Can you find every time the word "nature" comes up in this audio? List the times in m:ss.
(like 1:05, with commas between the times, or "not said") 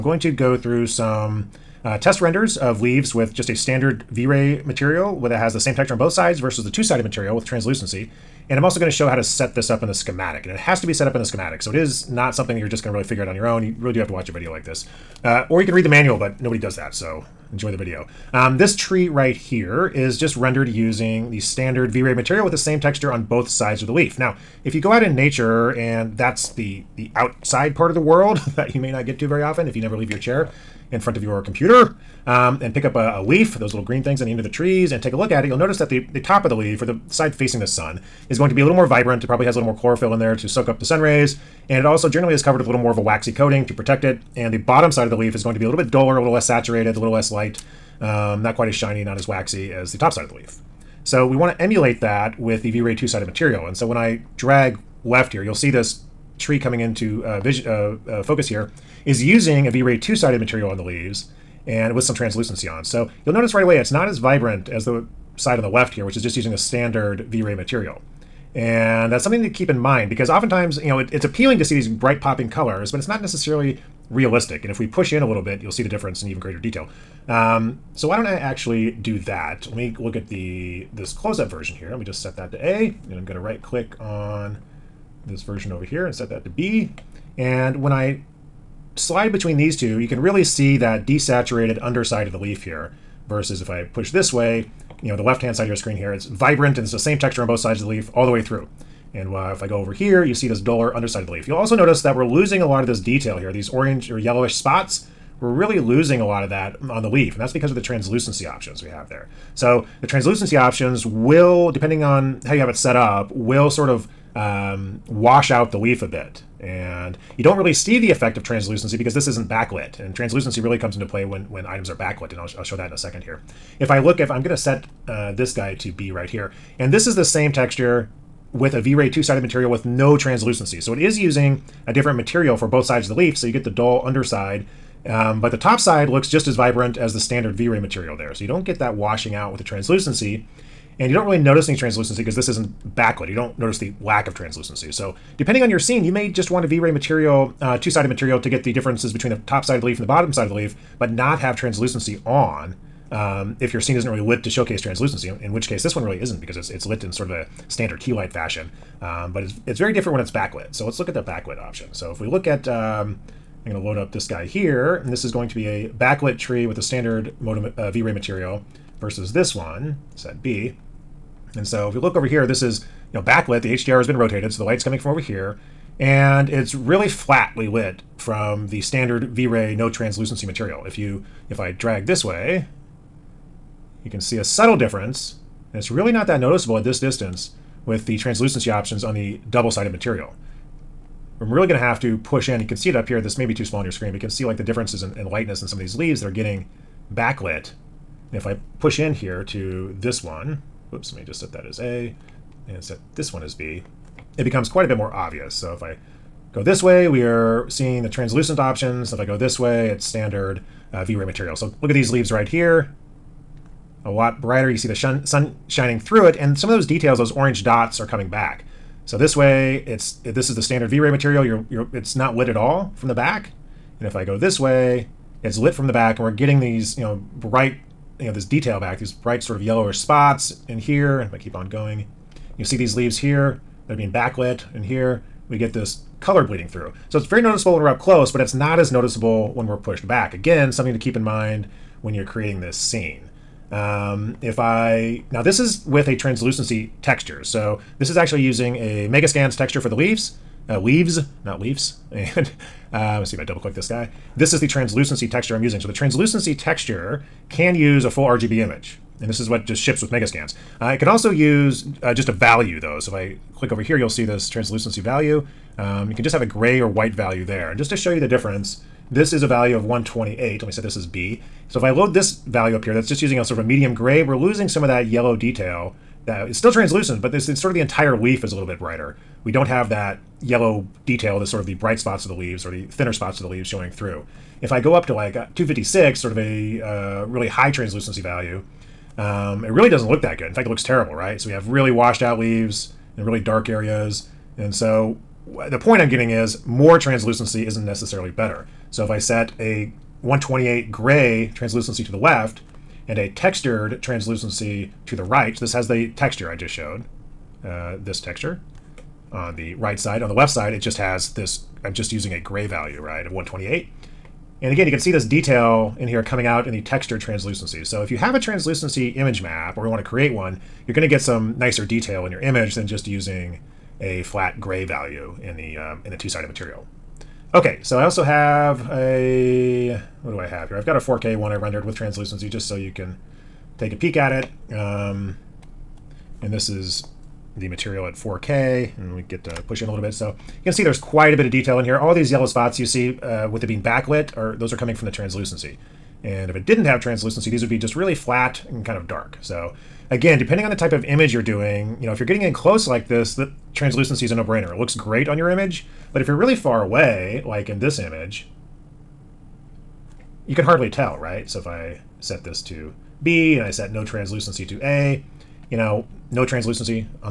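0:25.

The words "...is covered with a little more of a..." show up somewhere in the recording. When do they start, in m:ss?
0:42.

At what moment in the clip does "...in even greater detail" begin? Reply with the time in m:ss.
1:16.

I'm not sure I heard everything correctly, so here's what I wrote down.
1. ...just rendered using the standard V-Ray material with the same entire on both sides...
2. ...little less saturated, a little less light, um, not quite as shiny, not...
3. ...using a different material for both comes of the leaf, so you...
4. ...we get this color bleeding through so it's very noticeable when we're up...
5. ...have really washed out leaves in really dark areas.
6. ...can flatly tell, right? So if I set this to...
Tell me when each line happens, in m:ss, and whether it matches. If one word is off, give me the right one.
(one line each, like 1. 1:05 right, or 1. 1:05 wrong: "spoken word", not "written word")
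1. 0:20 wrong: "texture", not "entire"
2. 0:46 right
3. 2:11 wrong: "sides", not "comes"
4. 3:55 right
5. 4:51 right
6. 6:00 wrong: "hardly", not "flatly".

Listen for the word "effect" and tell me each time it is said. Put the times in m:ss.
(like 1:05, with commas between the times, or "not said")
1:58.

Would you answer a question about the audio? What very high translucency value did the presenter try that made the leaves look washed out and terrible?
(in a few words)
256.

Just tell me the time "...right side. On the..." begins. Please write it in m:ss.
5:09.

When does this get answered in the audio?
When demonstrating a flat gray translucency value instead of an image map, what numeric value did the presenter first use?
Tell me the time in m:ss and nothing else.
4:29.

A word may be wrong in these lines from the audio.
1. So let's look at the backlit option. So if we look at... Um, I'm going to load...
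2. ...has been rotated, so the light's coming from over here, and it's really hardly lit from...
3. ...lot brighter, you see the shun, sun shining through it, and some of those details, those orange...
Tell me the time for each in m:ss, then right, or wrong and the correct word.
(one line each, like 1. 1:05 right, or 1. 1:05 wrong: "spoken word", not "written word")
1. 2:40 right
2. 2:53 wrong: "flatly", not "hardly"
3. 3:34 right.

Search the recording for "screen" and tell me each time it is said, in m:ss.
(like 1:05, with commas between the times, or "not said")
1:35, 3:13.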